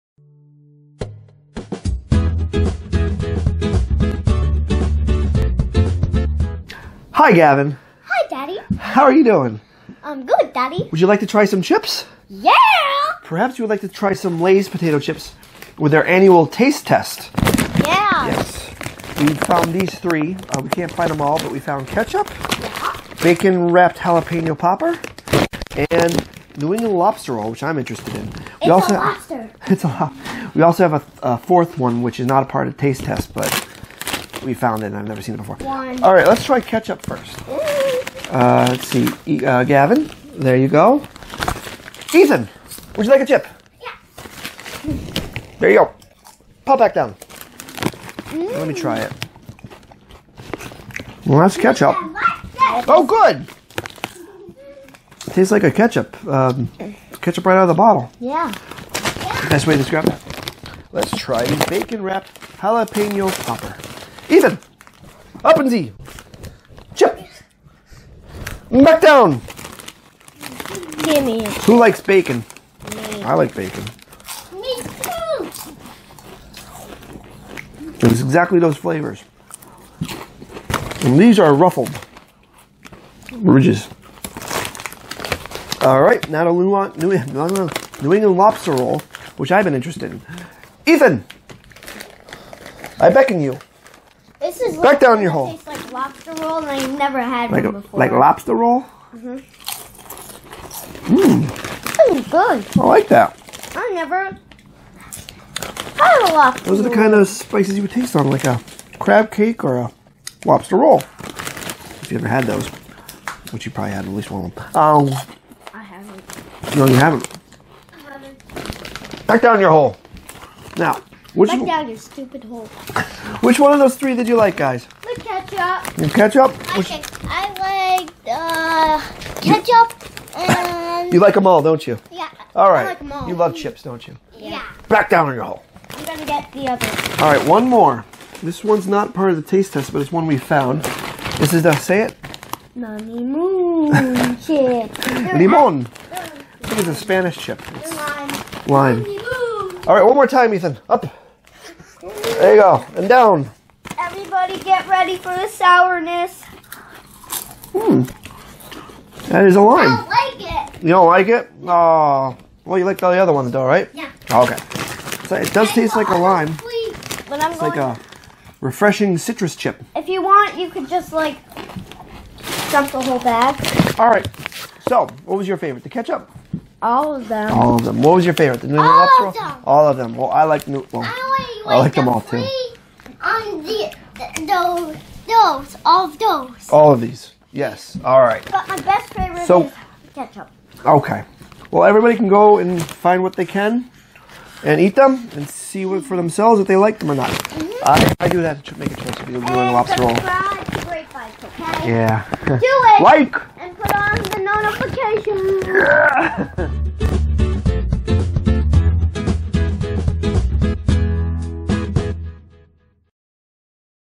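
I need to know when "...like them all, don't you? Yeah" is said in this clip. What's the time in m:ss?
2:11.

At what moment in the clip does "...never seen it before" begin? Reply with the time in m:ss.
0:35.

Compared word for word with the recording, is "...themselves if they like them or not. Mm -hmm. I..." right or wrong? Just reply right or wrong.
right.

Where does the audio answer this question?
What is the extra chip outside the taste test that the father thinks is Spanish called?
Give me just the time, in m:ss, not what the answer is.
2:25.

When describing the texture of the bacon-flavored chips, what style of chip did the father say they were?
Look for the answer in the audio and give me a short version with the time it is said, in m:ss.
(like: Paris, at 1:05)
ruffled ridges, at 1:21.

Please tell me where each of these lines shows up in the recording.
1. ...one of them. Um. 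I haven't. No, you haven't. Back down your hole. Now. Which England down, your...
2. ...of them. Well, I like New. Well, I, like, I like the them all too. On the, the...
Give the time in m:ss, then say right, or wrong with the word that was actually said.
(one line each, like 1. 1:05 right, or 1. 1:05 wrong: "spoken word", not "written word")
1. 1:54 wrong: "Back", not "England"
2. 2:59 right.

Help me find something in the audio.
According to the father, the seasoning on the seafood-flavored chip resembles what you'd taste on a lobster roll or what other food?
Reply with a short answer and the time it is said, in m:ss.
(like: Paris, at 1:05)
crab cake, at 1:48.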